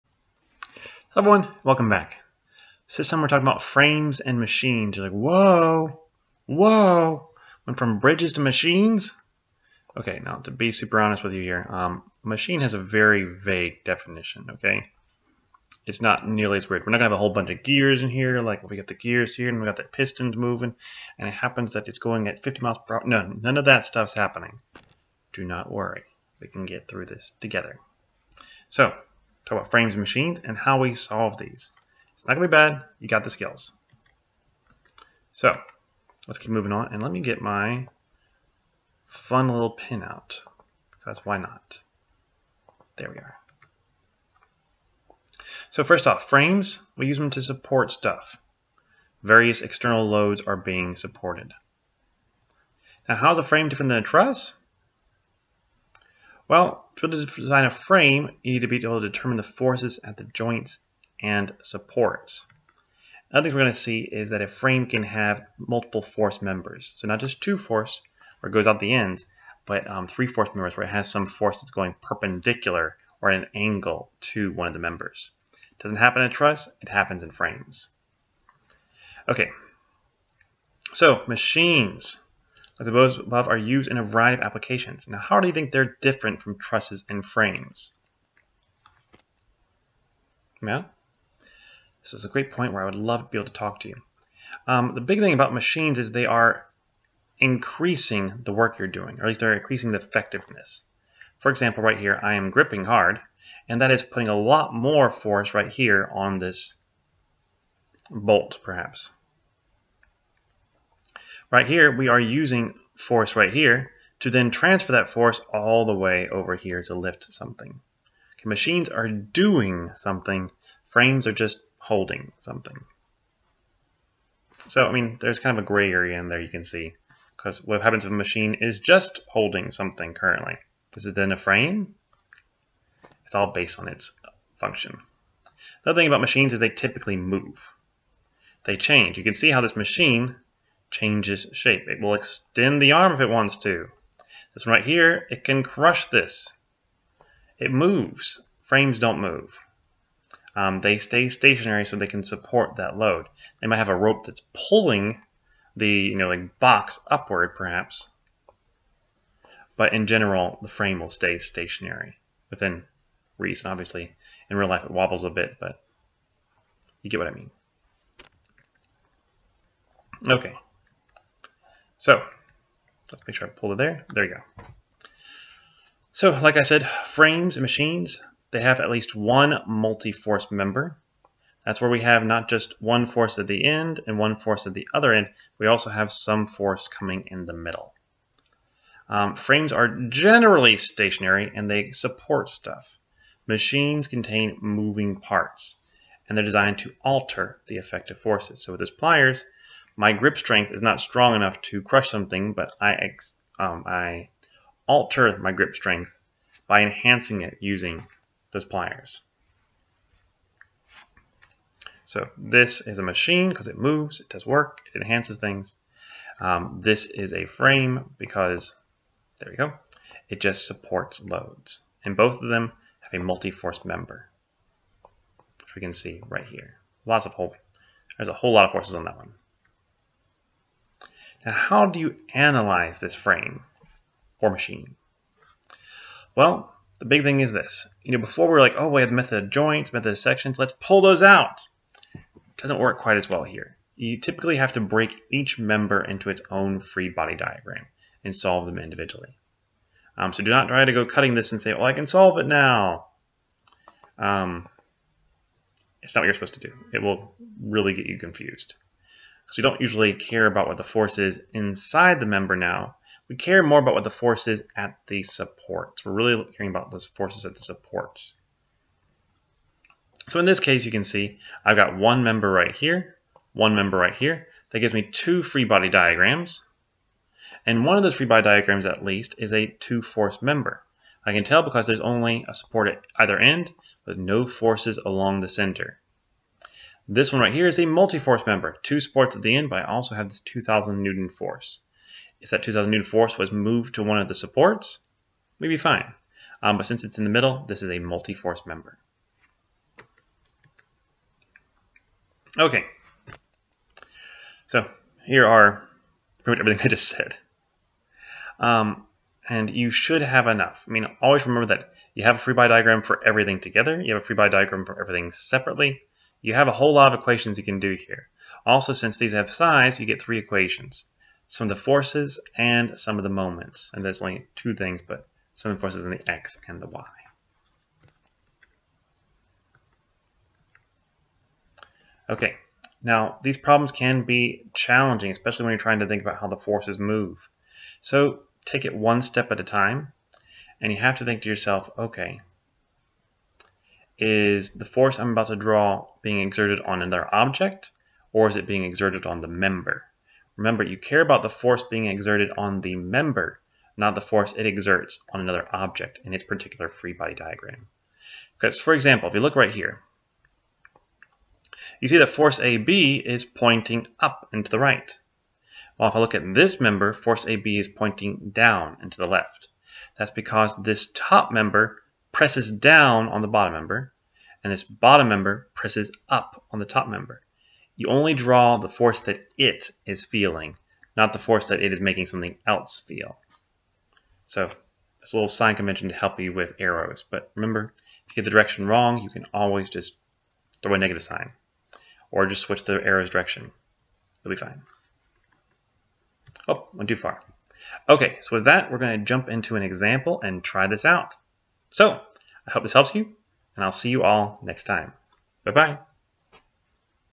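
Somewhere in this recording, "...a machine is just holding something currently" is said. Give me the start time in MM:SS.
02:08.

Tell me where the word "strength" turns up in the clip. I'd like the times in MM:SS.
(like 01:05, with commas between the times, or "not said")
03:20, 03:25.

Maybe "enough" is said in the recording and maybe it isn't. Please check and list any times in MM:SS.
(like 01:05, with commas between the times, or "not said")
03:21, 05:10.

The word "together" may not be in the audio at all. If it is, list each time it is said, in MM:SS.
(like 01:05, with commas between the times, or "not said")
00:27, 05:13.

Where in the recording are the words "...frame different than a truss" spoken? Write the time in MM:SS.
00:53.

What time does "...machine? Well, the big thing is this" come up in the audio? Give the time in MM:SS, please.
03:54.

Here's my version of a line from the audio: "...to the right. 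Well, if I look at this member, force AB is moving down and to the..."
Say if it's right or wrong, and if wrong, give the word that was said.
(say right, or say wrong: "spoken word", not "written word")
wrong: "pointing", not "moving".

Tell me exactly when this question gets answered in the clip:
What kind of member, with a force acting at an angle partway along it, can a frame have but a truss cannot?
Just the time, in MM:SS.
01:10.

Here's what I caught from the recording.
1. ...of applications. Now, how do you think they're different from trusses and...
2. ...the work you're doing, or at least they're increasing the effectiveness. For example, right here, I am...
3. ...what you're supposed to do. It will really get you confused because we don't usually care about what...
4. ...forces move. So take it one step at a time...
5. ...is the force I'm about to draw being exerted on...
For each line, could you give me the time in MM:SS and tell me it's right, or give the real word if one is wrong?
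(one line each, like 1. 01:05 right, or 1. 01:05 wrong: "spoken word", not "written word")
1. 01:24 right
2. 01:38 right
3. 04:16 right
4. 05:36 right
5. 05:44 right.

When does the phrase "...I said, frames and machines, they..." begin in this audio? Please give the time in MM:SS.
02:56.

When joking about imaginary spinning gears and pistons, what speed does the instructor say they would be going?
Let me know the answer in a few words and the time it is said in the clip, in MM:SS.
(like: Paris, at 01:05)
50 miles per hour, at 00:22.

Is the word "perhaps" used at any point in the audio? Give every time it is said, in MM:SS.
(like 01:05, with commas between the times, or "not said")
01:48, 02:37.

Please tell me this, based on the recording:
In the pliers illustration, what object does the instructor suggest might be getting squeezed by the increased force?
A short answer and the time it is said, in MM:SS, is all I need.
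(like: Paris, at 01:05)
bolt, at 01:48.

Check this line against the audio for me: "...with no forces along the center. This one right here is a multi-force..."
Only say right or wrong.
right.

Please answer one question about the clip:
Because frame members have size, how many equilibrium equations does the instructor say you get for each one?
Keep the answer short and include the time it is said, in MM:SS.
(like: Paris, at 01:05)
3, at 05:20.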